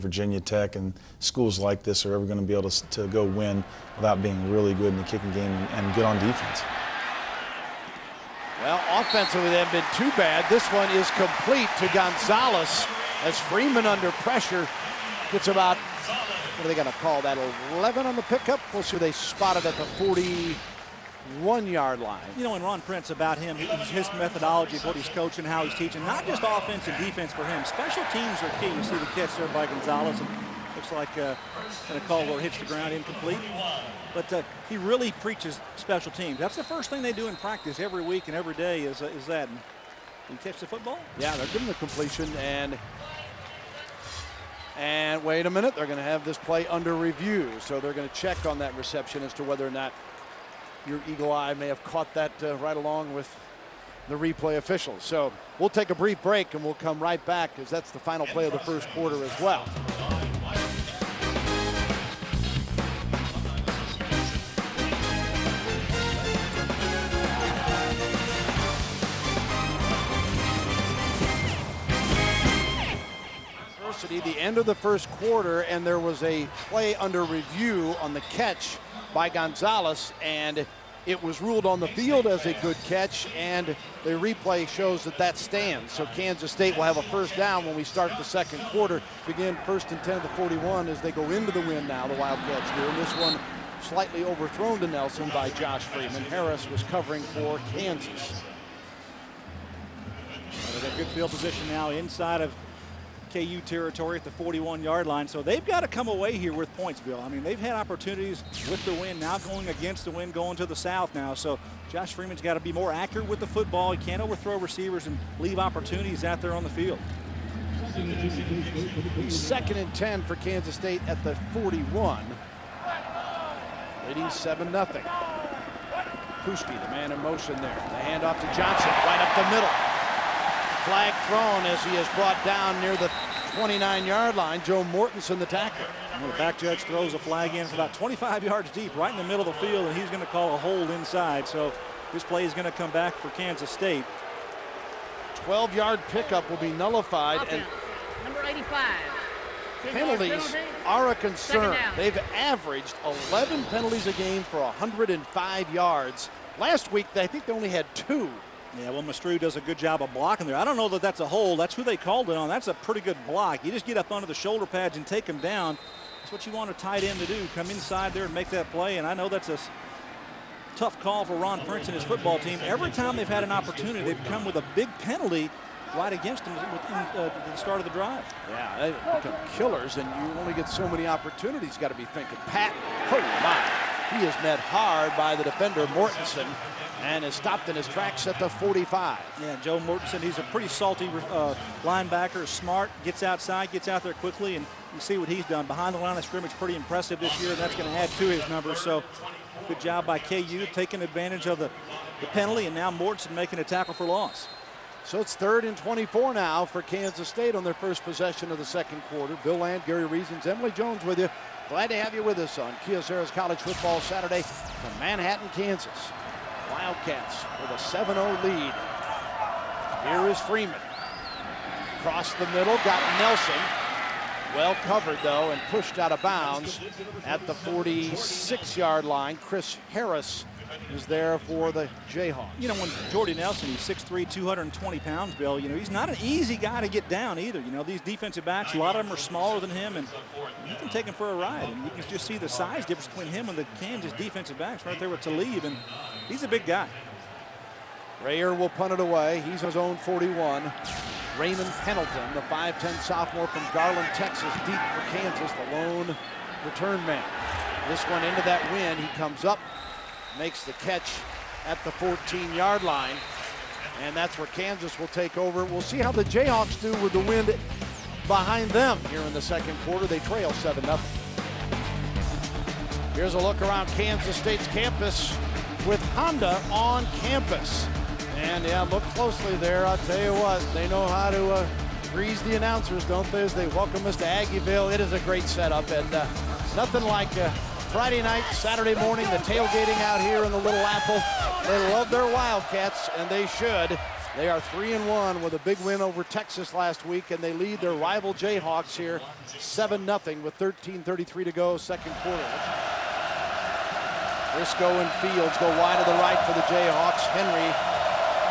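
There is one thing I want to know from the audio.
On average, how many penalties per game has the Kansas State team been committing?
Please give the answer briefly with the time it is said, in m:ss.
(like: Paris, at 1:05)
11, at 2:33.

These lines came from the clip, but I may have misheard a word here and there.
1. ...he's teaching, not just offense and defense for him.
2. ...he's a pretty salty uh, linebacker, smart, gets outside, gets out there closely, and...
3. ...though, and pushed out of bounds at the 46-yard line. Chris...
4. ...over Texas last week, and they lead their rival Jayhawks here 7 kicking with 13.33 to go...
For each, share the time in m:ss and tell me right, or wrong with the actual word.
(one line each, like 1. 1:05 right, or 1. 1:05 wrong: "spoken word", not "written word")
1. 0:25 right
2. 3:10 wrong: "quickly", not "closely"
3. 3:45 right
4. 4:56 wrong: "nothing", not "kicking".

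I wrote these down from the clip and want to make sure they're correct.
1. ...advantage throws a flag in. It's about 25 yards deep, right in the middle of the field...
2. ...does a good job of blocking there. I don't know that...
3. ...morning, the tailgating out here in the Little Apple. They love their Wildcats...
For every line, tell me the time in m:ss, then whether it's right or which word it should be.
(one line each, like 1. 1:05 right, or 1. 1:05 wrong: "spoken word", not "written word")
1. 2:16 wrong: "judge", not "advantage"
2. 2:39 right
3. 4:48 right.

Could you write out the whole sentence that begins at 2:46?
That's what you want a tight end to do.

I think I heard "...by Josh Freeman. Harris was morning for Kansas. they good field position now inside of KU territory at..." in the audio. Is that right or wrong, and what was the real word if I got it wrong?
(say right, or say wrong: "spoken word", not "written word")
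wrong: "covering", not "morning".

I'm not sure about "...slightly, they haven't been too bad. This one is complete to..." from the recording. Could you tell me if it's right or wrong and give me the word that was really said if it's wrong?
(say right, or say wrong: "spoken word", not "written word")
wrong: "offensively", not "slightly".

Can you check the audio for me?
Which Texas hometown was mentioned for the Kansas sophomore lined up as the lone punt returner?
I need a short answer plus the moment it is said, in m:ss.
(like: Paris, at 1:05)
Garland, Texas, at 4:13.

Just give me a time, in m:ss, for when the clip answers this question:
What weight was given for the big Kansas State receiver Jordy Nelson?
3:54.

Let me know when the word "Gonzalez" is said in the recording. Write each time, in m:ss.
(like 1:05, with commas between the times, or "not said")
0:11, 0:29, 1:19.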